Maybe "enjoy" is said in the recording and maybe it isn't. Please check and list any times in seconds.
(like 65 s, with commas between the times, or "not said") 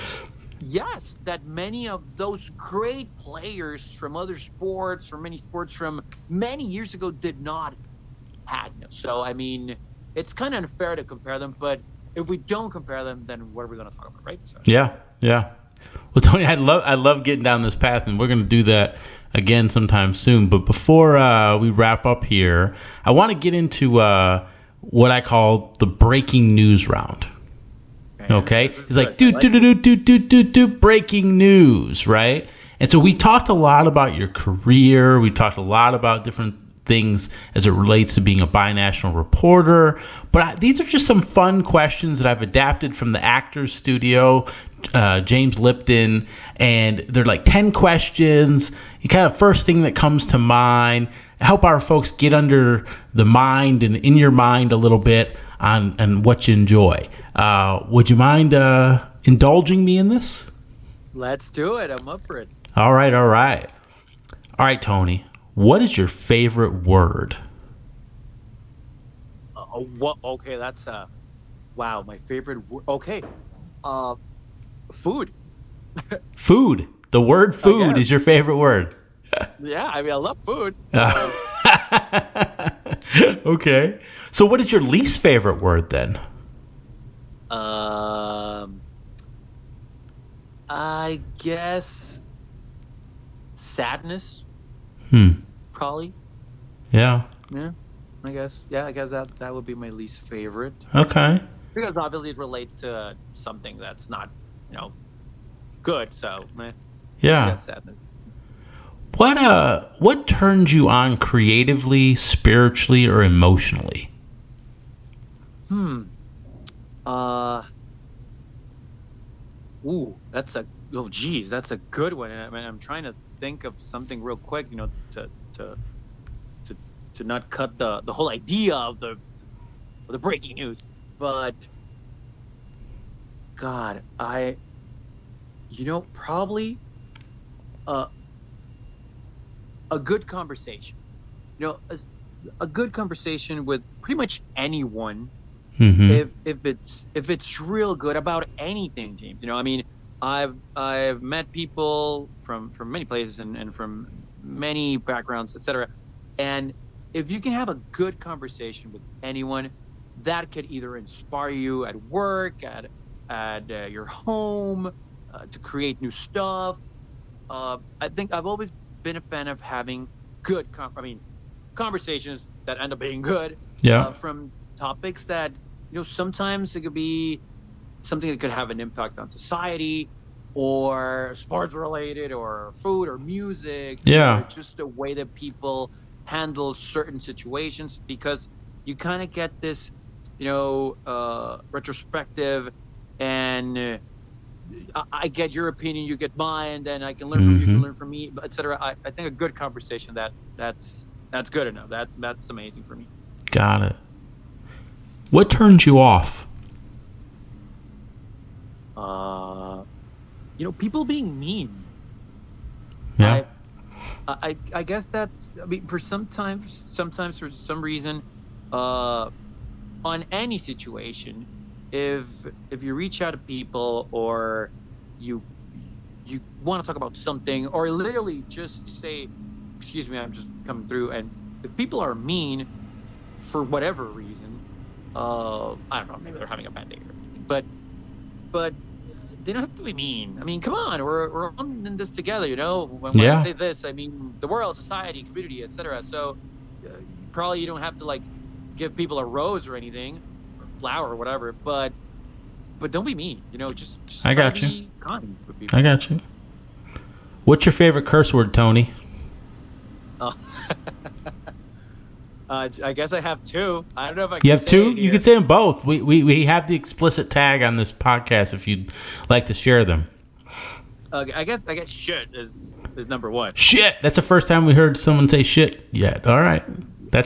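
56 s.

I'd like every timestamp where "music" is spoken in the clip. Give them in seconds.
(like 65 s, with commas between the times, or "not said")
183 s.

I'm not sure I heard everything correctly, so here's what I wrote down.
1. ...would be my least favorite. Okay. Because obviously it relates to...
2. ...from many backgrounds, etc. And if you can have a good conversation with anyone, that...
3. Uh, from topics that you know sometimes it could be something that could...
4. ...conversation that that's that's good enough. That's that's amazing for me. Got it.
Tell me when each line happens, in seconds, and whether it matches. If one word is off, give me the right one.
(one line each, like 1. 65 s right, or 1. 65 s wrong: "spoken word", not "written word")
1. 99 s right
2. 153 s right
3. 174 s right
4. 199 s right.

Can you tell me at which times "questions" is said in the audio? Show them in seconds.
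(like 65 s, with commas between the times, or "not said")
41 s, 47 s.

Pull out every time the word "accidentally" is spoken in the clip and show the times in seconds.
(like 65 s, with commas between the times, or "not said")
not said.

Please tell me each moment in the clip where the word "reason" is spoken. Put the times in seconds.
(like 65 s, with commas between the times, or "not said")
217 s, 234 s.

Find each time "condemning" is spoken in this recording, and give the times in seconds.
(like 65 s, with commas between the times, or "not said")
not said.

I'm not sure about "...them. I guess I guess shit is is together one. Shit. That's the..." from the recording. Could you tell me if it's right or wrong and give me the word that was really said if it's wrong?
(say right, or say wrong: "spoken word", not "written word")
wrong: "number", not "together".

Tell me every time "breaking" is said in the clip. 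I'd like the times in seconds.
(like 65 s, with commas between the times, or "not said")
25 s, 30 s, 130 s.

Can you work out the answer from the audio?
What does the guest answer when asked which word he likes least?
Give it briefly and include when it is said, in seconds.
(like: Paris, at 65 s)
Sadness, at 93 s.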